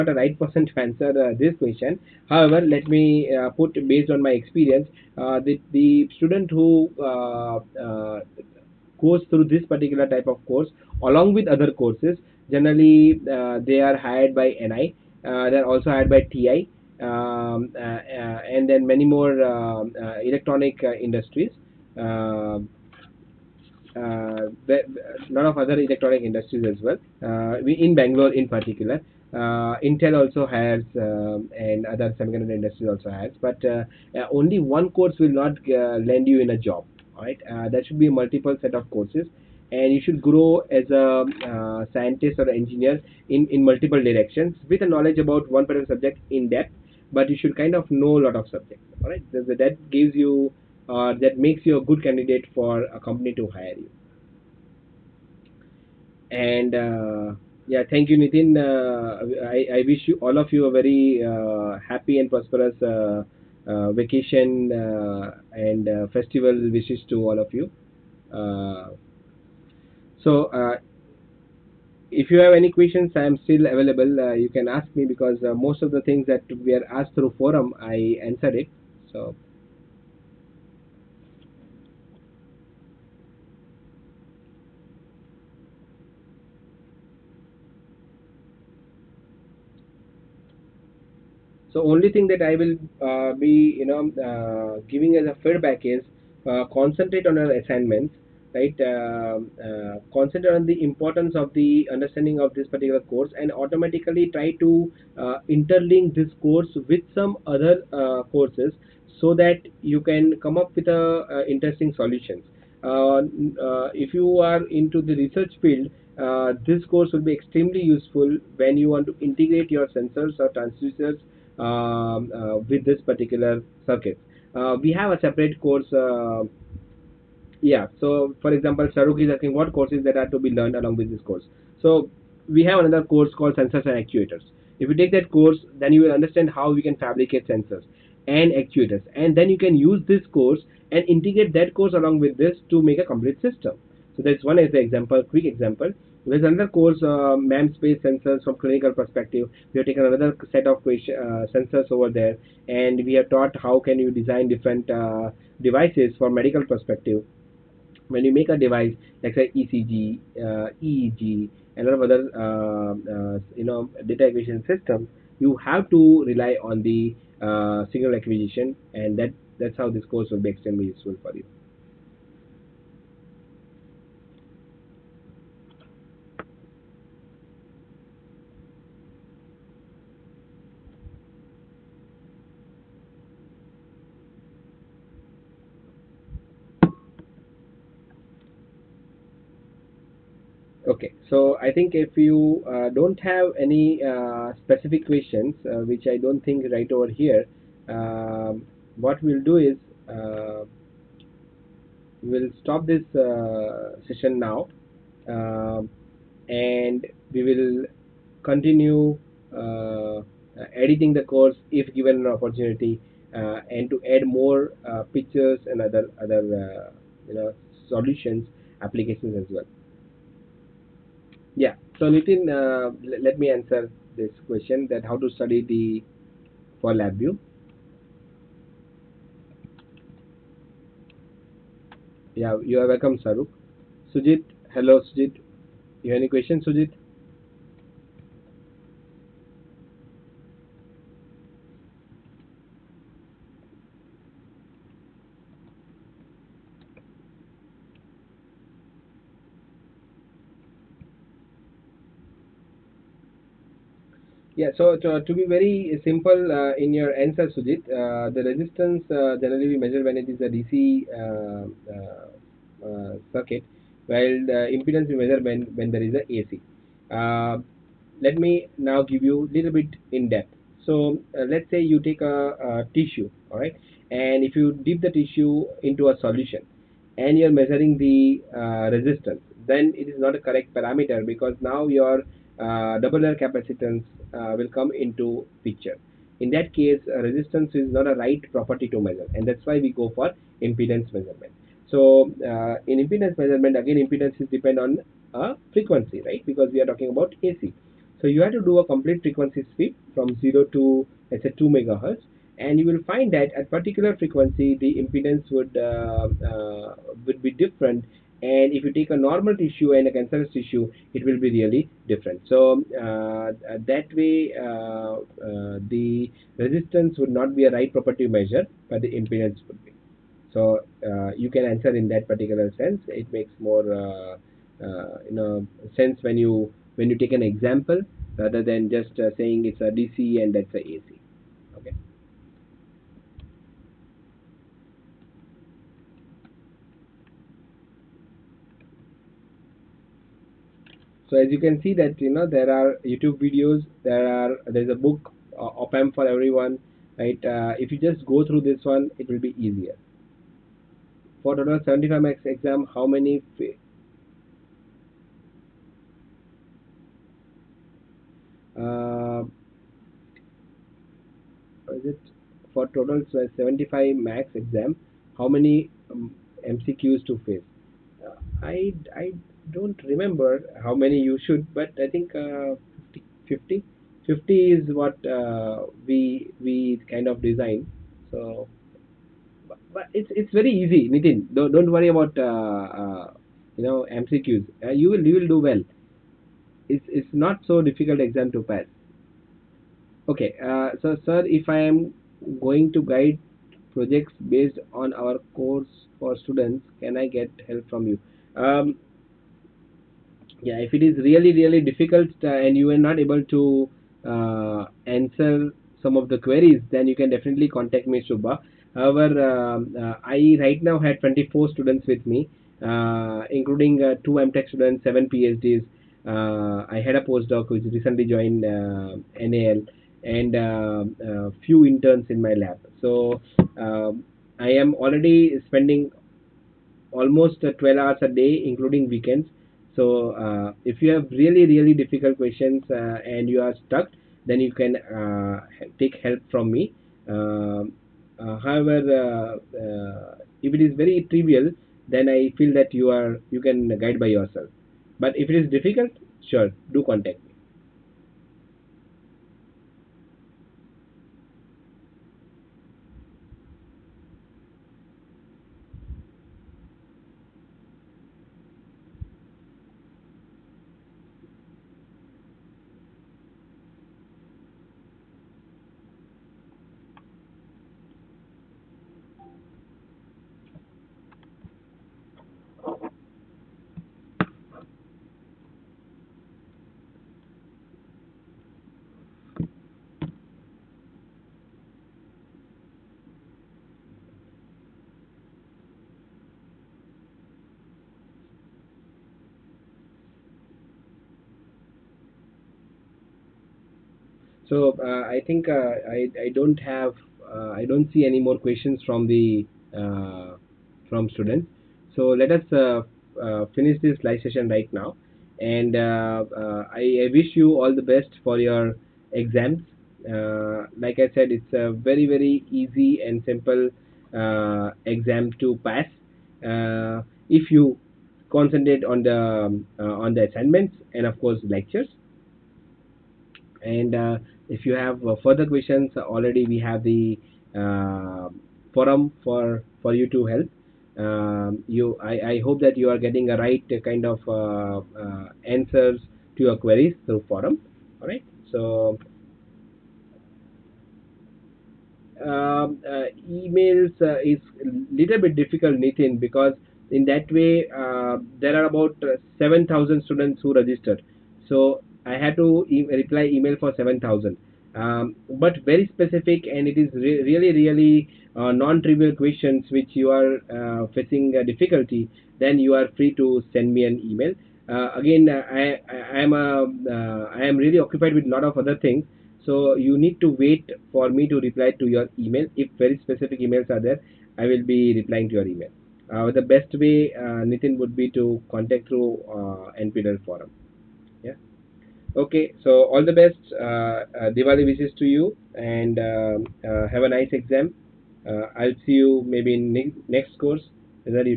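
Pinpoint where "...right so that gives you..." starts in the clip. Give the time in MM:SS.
00:49.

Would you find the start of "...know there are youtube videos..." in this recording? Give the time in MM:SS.
05:42.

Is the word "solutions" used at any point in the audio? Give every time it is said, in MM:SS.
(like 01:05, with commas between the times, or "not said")
01:51, 03:37, 04:36.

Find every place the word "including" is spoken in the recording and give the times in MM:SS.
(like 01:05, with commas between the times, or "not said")
06:52, 07:08.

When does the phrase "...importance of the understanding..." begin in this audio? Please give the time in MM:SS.
01:40.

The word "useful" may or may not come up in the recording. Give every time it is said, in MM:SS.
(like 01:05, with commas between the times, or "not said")
01:57, 02:50.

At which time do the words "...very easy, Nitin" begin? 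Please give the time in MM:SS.
06:20.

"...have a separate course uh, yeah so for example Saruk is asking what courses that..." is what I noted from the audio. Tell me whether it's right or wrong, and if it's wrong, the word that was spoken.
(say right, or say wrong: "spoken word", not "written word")
right.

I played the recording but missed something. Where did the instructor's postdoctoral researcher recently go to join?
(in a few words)
NAL.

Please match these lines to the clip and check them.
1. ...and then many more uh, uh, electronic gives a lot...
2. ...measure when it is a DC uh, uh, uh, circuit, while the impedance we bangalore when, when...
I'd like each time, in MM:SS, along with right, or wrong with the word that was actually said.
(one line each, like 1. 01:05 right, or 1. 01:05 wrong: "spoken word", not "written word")
1. 00:18 wrong: "industries", not "gives"
2. 04:19 wrong: "measure", not "bangalore".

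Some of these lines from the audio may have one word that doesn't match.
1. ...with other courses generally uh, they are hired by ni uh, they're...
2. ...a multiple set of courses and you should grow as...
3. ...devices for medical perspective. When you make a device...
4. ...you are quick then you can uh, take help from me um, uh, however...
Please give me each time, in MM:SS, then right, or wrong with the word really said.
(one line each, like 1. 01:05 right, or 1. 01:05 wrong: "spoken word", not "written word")
1. 00:11 right
2. 00:38 right
3. 02:35 right
4. 07:13 wrong: "stuck", not "quick".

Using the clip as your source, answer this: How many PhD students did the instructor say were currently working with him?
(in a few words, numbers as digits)
7.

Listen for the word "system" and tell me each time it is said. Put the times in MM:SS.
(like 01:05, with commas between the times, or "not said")
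02:23, 02:44.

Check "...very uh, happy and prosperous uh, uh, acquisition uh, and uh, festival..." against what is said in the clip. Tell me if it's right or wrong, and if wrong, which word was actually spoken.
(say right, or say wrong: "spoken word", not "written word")
wrong: "vacation", not "acquisition".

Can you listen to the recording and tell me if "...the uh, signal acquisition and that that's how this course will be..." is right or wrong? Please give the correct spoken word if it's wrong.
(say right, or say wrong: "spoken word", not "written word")
right.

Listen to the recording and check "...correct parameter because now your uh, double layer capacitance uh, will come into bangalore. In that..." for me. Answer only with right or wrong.
wrong.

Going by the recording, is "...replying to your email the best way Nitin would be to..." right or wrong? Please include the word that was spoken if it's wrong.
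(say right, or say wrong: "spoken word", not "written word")
right.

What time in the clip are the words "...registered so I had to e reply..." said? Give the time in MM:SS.
09:10.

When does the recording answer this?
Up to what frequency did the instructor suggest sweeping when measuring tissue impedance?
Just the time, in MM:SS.
05:01.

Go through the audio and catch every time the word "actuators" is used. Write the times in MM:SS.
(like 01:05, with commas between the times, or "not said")
02:14, 02:18.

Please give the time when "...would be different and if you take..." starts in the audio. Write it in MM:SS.
05:07.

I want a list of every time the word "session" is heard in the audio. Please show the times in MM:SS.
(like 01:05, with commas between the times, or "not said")
03:24, 08:24.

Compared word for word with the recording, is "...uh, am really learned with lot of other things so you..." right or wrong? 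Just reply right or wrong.
wrong.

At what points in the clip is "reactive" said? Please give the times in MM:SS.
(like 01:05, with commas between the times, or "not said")
not said.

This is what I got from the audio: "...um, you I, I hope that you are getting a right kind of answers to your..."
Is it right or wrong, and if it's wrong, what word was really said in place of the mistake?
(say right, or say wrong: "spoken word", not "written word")
right.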